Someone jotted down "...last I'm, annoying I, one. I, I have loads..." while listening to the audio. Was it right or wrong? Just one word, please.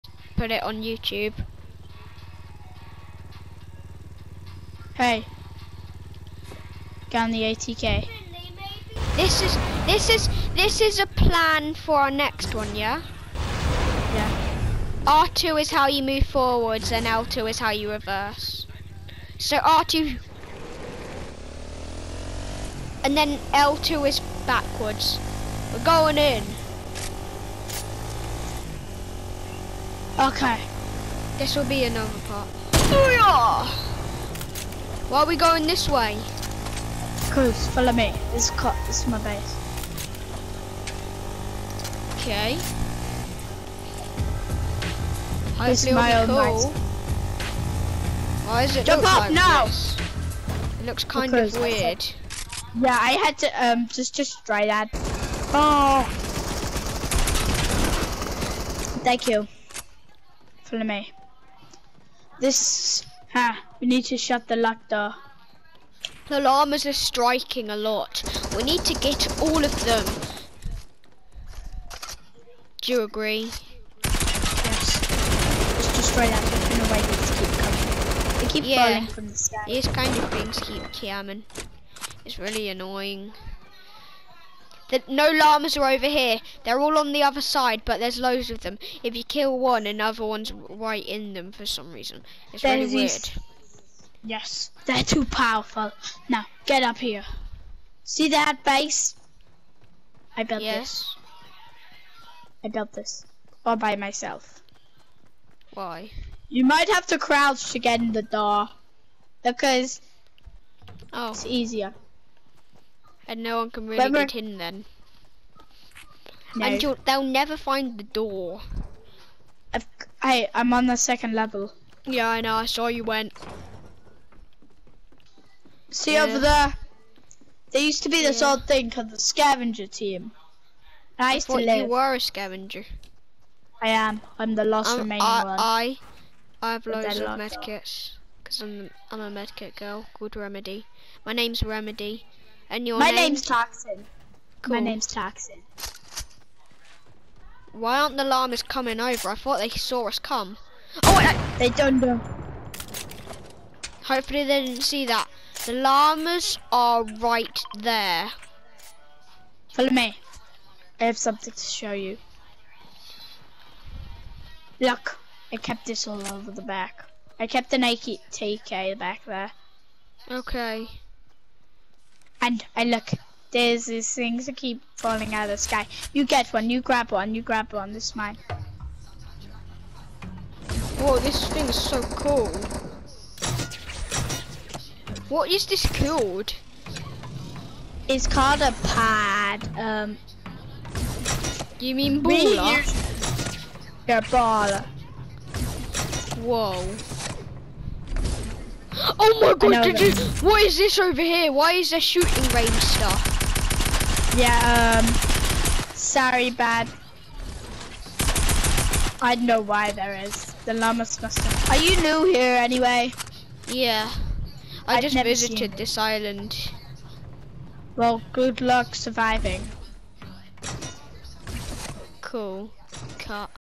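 wrong.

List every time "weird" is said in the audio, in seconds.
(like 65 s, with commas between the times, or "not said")
51 s, 92 s.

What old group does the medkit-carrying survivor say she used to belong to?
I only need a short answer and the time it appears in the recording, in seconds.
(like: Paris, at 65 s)
the scavenger team, at 129 s.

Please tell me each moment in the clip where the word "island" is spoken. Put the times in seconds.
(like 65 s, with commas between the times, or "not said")
215 s.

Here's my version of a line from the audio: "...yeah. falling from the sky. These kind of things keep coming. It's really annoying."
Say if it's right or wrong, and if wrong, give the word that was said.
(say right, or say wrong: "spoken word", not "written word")
right.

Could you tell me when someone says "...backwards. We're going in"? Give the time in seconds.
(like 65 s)
24 s.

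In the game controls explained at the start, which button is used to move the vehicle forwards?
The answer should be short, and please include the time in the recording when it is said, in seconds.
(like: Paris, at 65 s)
R2, at 15 s.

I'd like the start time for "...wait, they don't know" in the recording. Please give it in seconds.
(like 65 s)
151 s.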